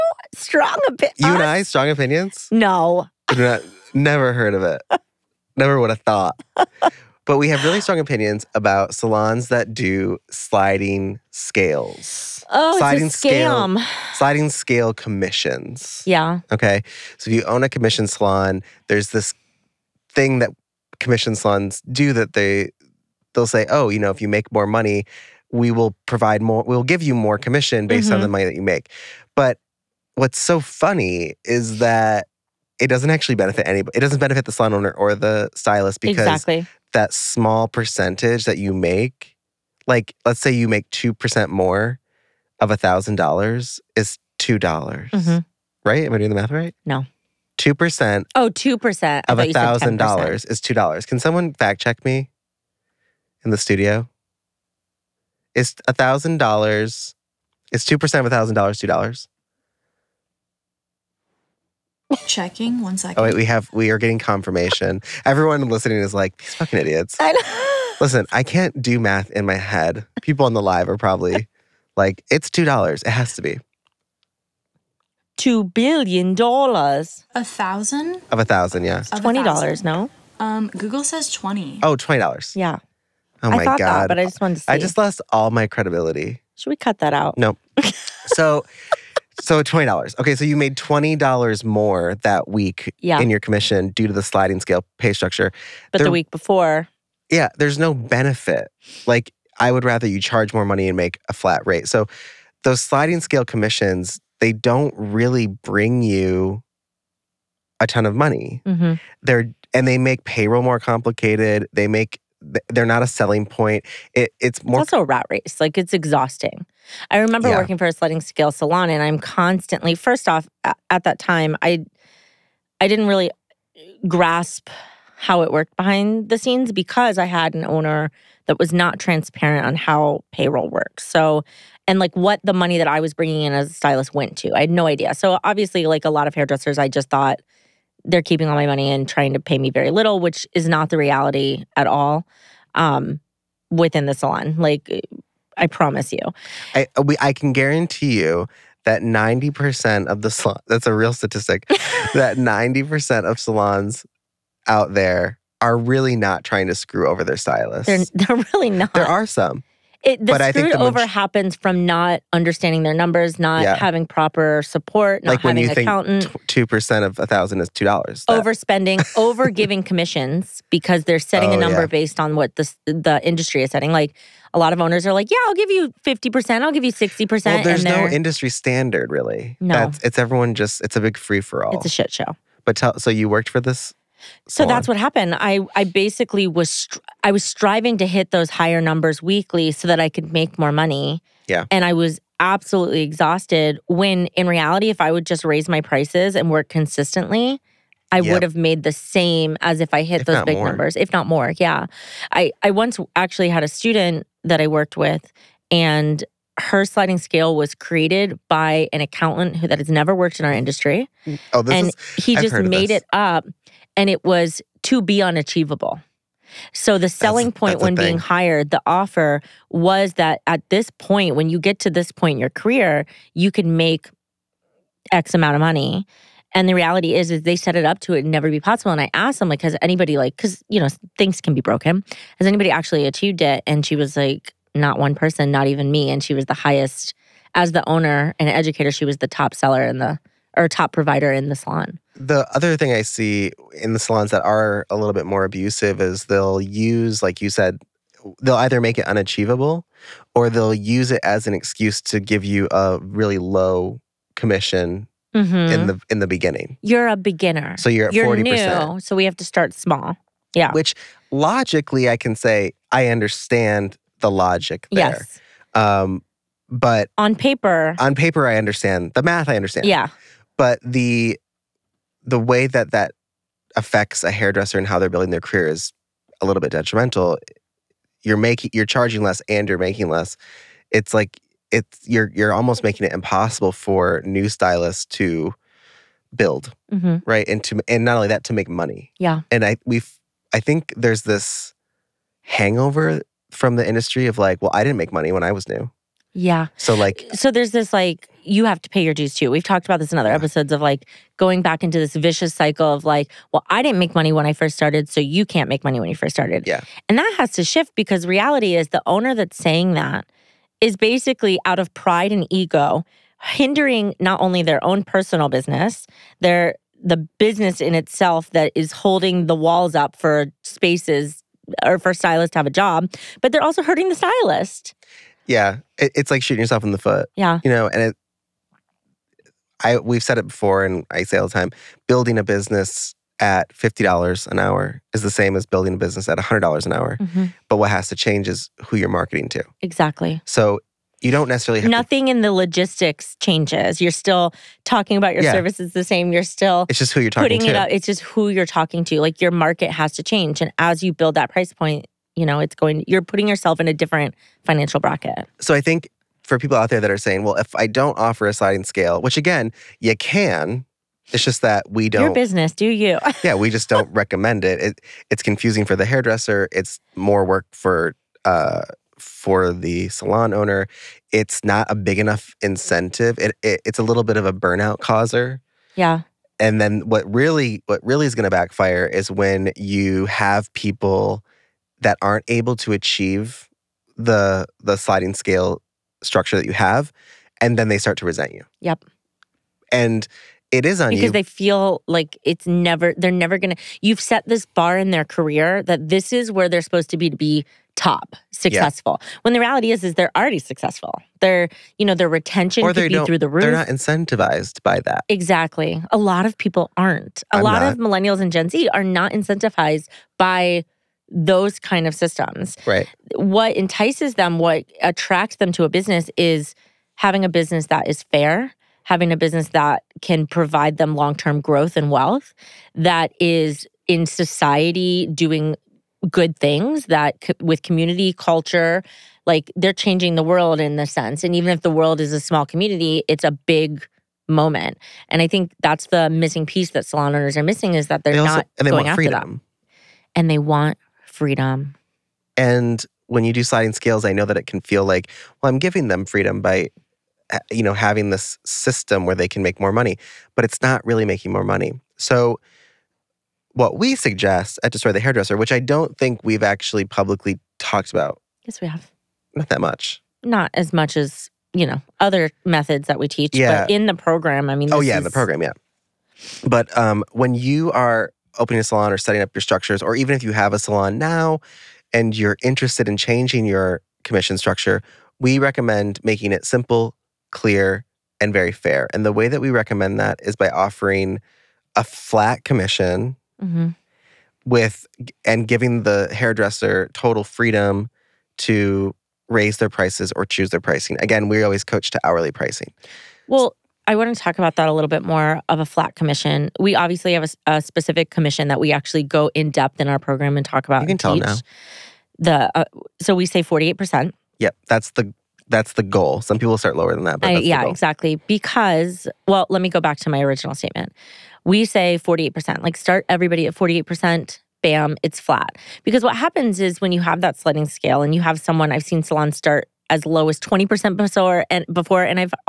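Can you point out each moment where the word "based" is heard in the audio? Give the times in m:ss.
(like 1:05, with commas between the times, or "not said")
0:27, 2:51.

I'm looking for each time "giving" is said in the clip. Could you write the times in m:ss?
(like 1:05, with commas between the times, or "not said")
2:49, 7:25, 8:05.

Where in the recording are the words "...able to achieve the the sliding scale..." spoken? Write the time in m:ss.
6:22.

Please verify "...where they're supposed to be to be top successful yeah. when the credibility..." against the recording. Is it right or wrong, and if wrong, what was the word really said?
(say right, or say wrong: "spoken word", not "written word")
wrong: "reality", not "credibility".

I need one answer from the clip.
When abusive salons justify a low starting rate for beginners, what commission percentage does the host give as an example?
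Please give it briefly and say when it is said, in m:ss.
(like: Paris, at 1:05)
40%, at 4:18.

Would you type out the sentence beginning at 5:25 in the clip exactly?
Yeah, it, it's like shooting yourself in the foot.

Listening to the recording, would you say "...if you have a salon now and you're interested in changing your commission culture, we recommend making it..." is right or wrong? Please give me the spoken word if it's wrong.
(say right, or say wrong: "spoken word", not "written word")
wrong: "structure", not "culture".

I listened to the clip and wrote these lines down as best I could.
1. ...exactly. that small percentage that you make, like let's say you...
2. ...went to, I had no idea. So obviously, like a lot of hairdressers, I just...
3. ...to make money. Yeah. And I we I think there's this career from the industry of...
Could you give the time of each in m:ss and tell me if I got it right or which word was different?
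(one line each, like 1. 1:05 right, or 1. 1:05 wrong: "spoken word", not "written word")
1. 0:36 right
2. 2:14 right
3. 4:48 wrong: "hangover", not "career".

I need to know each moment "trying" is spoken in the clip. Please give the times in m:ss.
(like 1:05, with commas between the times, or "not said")
2:19, 2:36.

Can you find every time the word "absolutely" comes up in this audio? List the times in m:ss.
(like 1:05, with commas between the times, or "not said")
3:12.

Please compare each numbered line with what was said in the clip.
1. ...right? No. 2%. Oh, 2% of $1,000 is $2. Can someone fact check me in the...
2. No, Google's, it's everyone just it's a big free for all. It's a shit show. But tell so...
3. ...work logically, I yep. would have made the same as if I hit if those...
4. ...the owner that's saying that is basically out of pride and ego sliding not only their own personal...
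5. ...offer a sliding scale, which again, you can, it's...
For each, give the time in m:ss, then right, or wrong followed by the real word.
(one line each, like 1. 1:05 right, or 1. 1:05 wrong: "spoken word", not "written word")
1. 0:46 right
2. 2:59 wrong: "That", not "Google"
3. 3:16 wrong: "consistently", not "logically"
4. 5:08 wrong: "hindering", not "sliding"
5. 5:58 right.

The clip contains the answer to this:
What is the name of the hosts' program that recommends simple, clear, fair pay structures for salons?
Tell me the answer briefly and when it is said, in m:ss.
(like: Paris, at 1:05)
Destroy the Hairdresser, at 7:34.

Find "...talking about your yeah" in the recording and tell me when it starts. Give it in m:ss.
5:44.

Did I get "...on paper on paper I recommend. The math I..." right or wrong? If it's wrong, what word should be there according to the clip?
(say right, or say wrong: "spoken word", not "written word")
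wrong: "understand", not "recommend".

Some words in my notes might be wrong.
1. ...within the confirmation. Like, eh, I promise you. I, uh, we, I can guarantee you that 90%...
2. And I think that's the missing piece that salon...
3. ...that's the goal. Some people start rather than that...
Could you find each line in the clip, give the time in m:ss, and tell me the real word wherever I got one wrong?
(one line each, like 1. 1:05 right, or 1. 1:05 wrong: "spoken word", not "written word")
1. 2:23 wrong: "salon", not "confirmation"
2. 7:15 right
3. 8:25 wrong: "lower", not "rather".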